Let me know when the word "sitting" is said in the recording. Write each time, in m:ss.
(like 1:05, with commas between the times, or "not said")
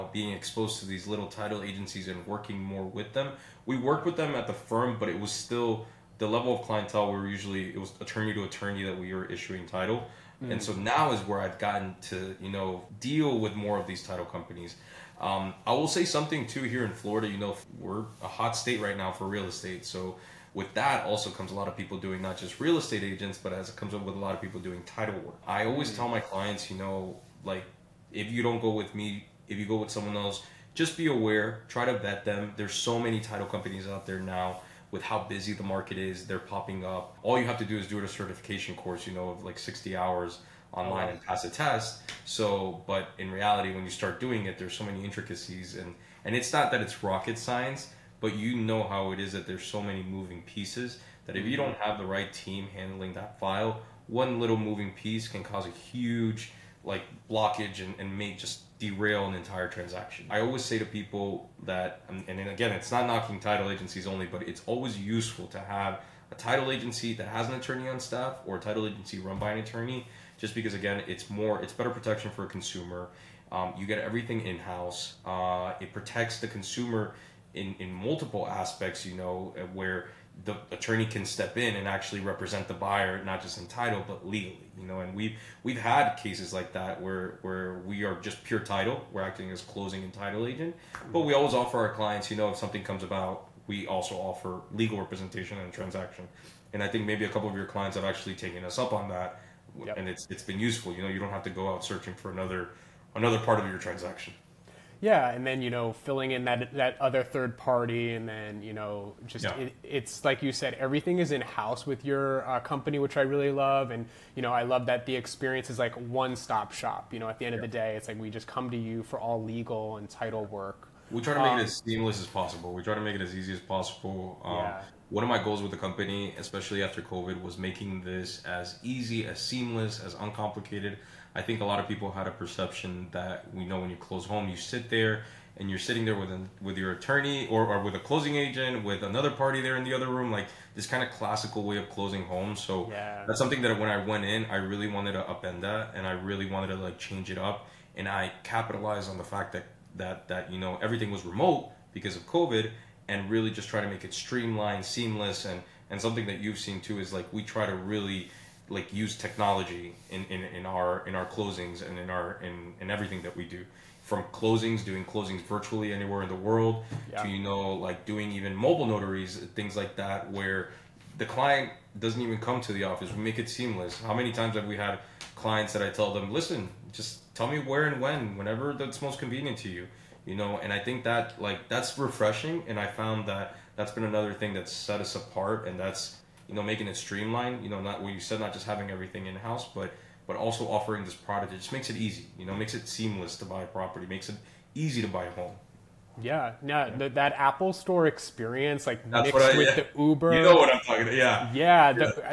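2:15.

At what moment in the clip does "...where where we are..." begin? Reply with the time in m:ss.
1:27.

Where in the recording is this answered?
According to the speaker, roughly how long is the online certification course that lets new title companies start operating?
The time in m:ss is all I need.
0:39.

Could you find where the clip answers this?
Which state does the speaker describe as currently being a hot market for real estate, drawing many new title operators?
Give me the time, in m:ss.
0:16.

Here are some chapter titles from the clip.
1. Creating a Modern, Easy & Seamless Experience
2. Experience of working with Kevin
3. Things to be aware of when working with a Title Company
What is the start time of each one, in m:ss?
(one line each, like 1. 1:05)
1. 2:07
2. 1:51
3. 0:16.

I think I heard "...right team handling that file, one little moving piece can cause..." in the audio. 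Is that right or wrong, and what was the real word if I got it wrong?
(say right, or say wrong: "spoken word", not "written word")
right.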